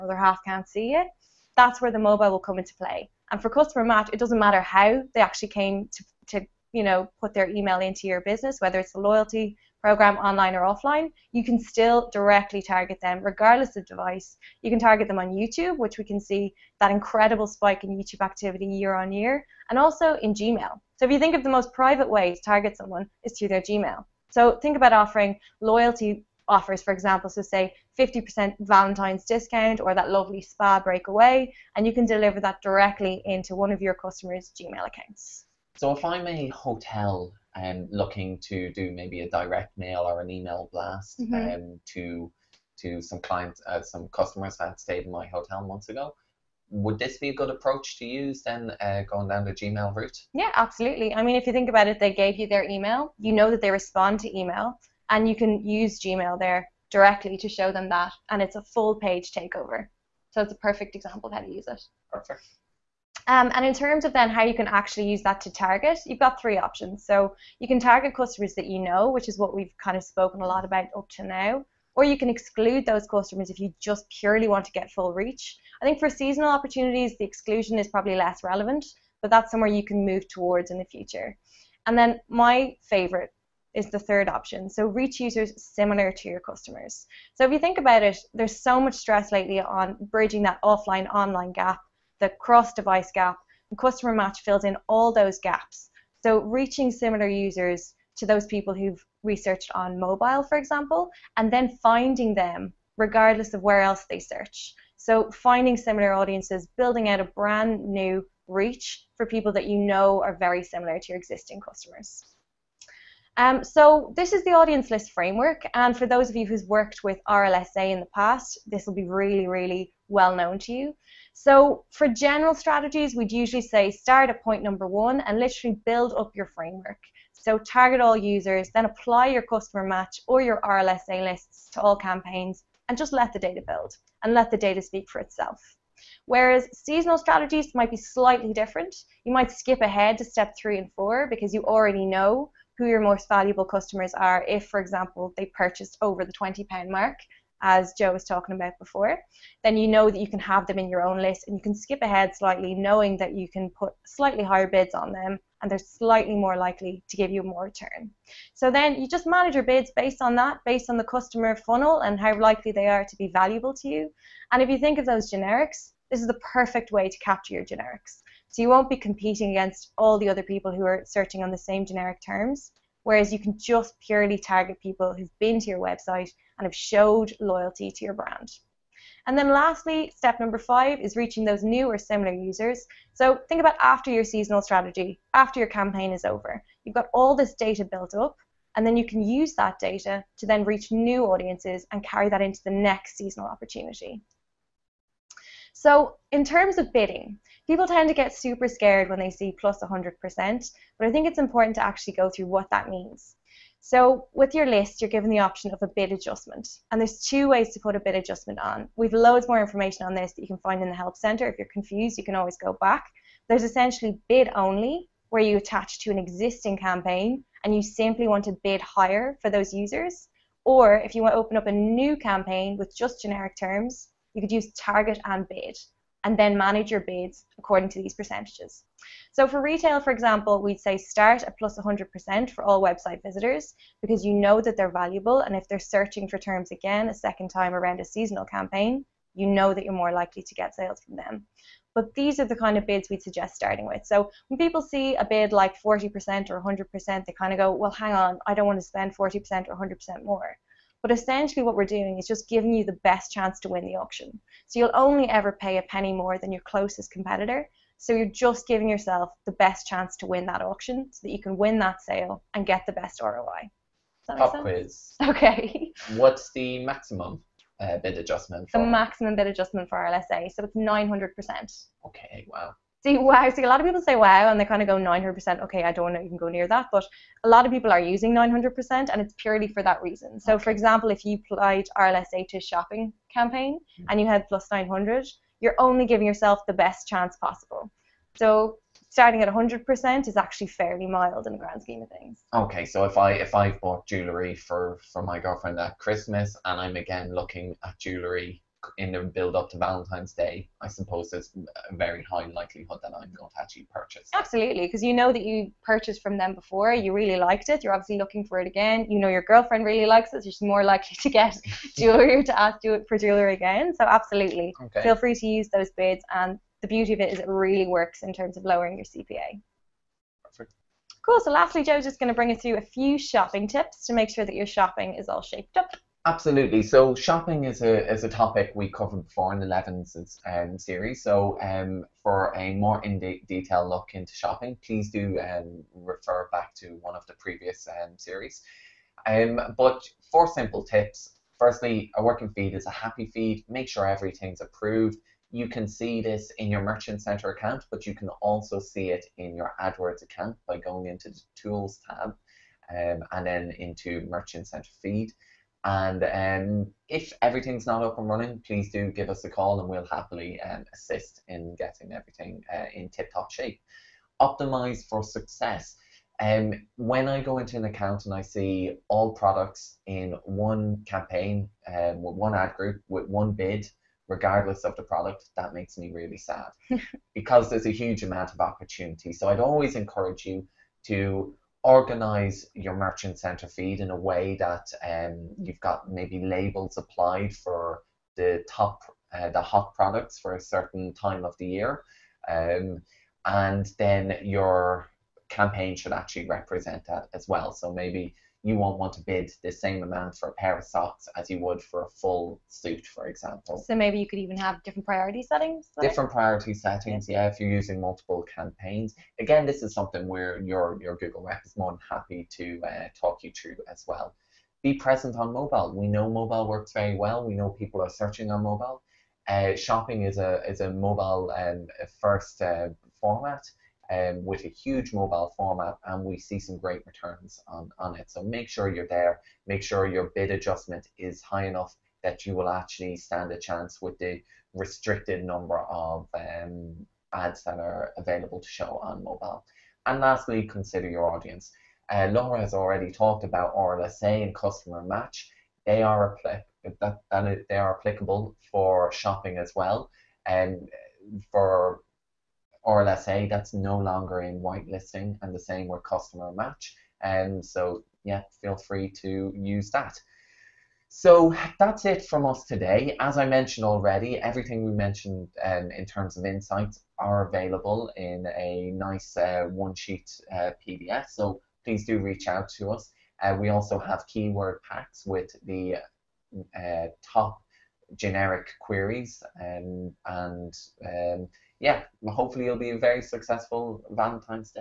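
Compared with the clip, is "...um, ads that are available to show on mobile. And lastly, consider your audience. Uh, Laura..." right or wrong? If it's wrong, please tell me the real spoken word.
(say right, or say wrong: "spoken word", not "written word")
right.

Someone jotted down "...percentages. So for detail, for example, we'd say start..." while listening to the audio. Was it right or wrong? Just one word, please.
wrong.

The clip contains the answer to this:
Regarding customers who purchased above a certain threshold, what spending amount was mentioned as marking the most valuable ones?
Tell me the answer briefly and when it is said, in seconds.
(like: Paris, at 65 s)
£20, at 146 s.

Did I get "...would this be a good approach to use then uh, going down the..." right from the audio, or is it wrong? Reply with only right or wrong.
right.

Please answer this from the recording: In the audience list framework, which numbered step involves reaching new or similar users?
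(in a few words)
5.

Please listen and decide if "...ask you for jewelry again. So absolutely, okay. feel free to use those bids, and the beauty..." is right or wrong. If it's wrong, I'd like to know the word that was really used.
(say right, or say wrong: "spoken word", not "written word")
right.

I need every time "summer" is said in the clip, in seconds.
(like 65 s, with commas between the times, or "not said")
not said.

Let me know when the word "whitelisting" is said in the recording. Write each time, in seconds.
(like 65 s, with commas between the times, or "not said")
454 s.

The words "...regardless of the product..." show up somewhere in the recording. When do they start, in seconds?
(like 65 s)
374 s.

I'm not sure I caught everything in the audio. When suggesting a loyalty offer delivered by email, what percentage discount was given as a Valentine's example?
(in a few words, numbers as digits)
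50%.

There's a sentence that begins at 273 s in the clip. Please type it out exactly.
See, a lot of people say wow, and they kind of go 900%.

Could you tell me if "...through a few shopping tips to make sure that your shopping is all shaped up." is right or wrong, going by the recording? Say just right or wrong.
right.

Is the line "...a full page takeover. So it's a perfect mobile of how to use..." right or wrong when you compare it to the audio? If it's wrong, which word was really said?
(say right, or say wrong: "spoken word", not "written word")
wrong: "example", not "mobile".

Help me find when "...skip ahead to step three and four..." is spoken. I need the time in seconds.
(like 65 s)
139 s.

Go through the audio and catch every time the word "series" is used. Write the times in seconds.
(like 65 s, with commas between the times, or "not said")
330 s, 338 s.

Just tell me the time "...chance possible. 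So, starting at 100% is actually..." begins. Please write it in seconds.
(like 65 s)
287 s.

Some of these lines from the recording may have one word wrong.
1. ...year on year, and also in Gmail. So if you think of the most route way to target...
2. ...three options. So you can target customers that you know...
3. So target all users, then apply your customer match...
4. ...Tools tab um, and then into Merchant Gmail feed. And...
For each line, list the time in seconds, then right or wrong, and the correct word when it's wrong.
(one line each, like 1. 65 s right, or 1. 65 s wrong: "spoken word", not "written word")
1. 18 s wrong: "private", not "route"
2. 66 s right
3. 127 s right
4. 351 s wrong: "Center", not "Gmail".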